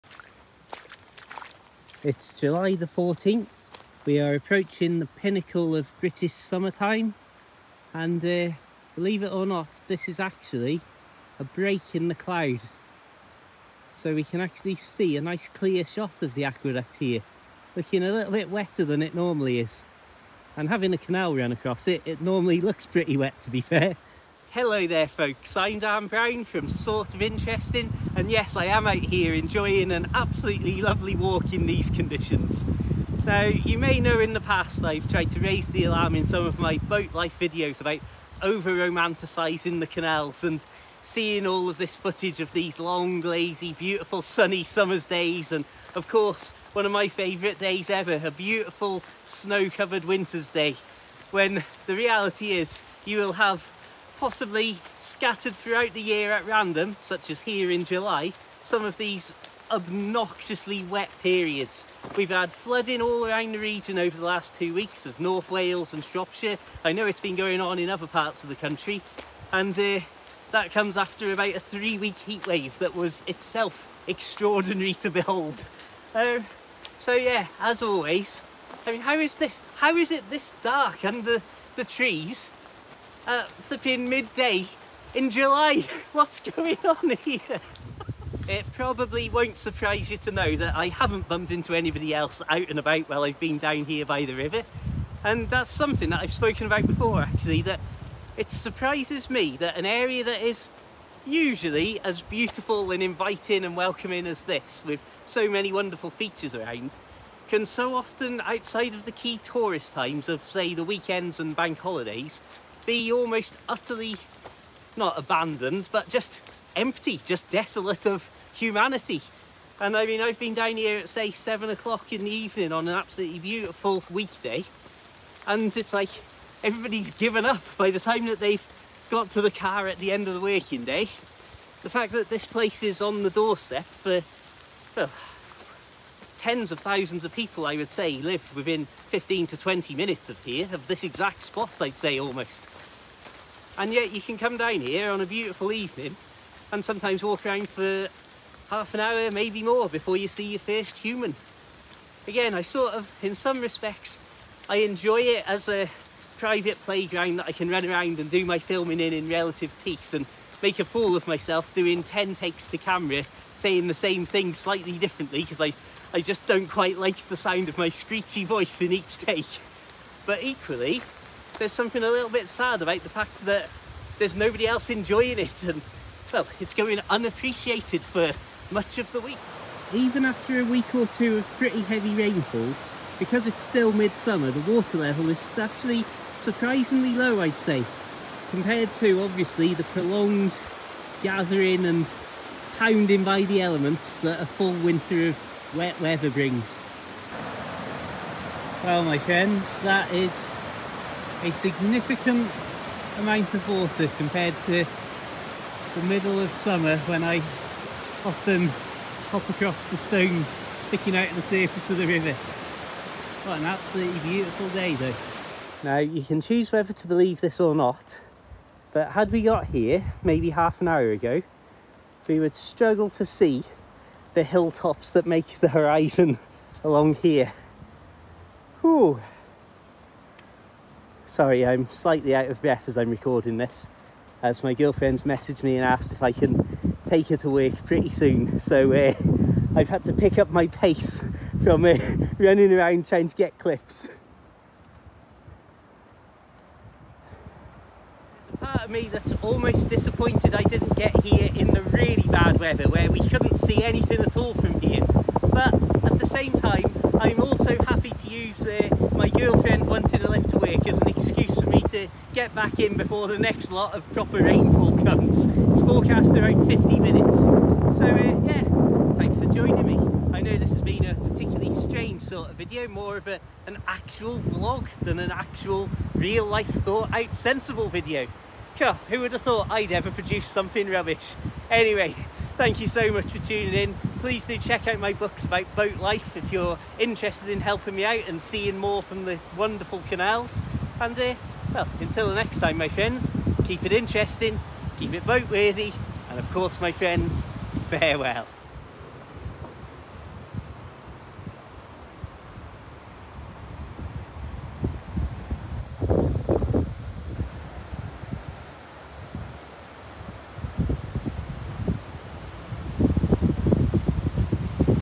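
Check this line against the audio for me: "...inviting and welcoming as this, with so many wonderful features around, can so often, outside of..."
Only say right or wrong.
right.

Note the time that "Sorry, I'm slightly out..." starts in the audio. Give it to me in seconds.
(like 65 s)
231 s.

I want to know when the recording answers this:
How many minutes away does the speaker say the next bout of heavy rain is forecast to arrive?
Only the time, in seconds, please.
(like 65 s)
266 s.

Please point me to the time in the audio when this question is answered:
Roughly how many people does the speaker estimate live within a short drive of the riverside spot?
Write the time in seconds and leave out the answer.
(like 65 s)
136 s.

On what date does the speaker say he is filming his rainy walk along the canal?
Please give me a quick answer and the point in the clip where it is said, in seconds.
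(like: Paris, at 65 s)
July 14th, at 2 s.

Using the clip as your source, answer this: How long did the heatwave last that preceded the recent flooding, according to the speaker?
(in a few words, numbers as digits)
About 3 weeks.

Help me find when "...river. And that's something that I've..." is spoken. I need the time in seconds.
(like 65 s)
94 s.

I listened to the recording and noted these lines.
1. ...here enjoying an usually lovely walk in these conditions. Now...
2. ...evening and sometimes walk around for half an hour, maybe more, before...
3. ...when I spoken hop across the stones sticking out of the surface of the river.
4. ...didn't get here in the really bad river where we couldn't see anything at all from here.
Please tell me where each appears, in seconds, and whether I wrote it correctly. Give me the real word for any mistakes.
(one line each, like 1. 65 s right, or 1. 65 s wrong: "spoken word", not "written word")
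1. 28 s wrong: "absolutely", not "usually"
2. 145 s right
3. 206 s wrong: "often", not "spoken"
4. 250 s wrong: "weather", not "river".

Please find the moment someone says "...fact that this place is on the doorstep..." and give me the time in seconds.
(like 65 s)
131 s.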